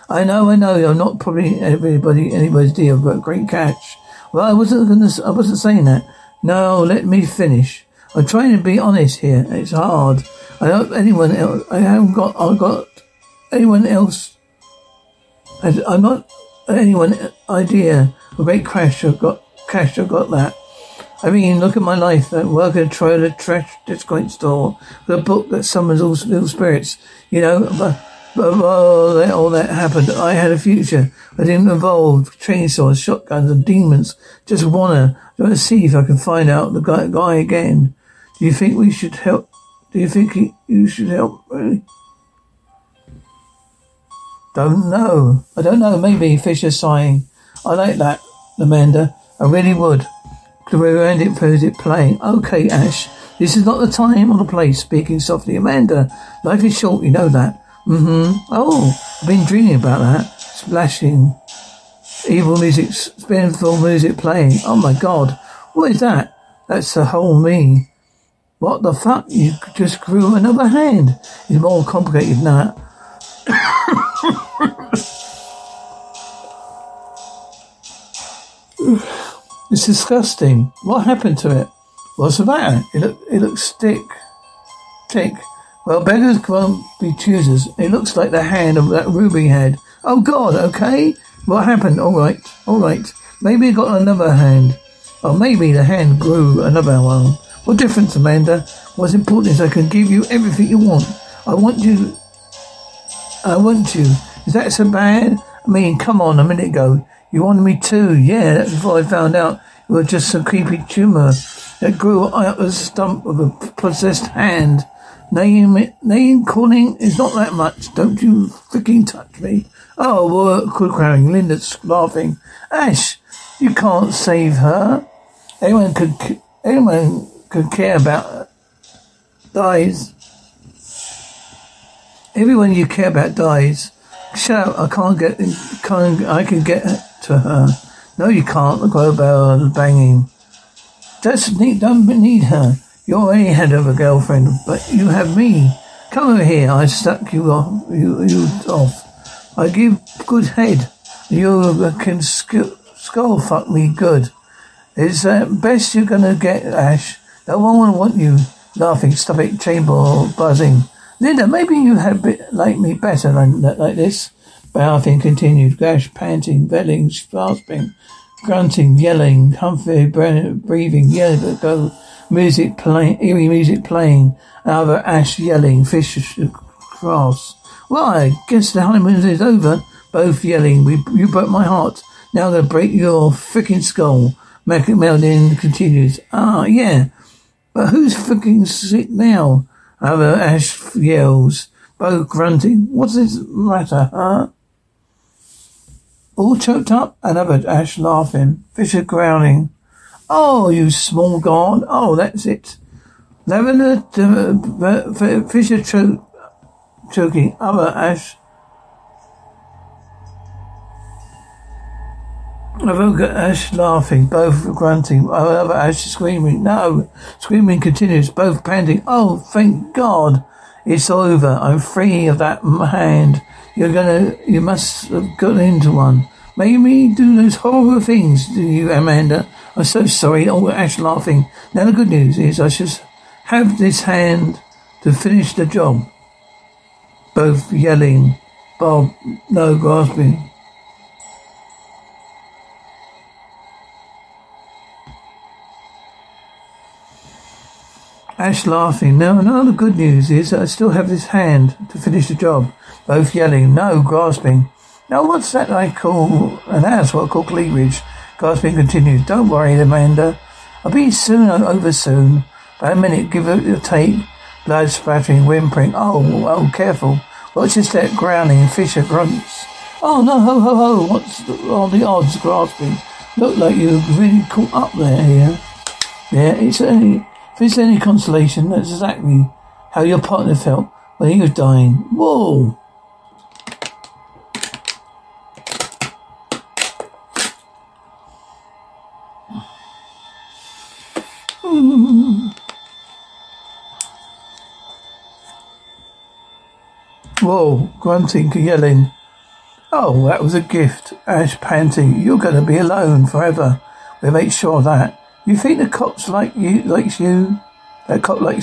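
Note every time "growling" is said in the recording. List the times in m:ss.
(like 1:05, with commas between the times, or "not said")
3:19, 4:28.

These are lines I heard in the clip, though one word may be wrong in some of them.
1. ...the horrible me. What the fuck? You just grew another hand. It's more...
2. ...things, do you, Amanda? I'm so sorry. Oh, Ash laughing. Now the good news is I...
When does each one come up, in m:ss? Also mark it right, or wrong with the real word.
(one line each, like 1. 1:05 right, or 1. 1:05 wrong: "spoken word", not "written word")
1. 1:06 wrong: "whole", not "horrible"
2. 3:47 right.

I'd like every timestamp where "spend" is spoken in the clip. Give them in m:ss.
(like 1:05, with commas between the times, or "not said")
not said.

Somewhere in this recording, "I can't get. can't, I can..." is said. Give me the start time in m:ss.
2:14.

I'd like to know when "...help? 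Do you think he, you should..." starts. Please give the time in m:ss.
0:39.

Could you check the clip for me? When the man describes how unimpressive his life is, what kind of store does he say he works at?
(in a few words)
discount store.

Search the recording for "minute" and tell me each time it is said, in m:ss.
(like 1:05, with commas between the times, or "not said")
1:46, 4:22.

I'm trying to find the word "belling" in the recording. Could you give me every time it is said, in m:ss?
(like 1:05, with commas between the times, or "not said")
2:46.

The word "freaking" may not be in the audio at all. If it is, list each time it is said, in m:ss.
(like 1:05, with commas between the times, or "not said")
1:58, 3:03, 3:08.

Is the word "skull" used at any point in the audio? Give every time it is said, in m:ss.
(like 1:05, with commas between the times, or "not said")
2:32, 3:03.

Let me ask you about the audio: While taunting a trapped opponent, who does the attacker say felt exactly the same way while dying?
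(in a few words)
your partner.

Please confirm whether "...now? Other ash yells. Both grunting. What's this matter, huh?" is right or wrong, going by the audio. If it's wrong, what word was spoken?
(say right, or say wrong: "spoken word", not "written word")
right.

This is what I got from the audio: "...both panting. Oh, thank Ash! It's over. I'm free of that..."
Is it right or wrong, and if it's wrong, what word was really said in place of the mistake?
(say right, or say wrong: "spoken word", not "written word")
wrong: "God", not "Ash".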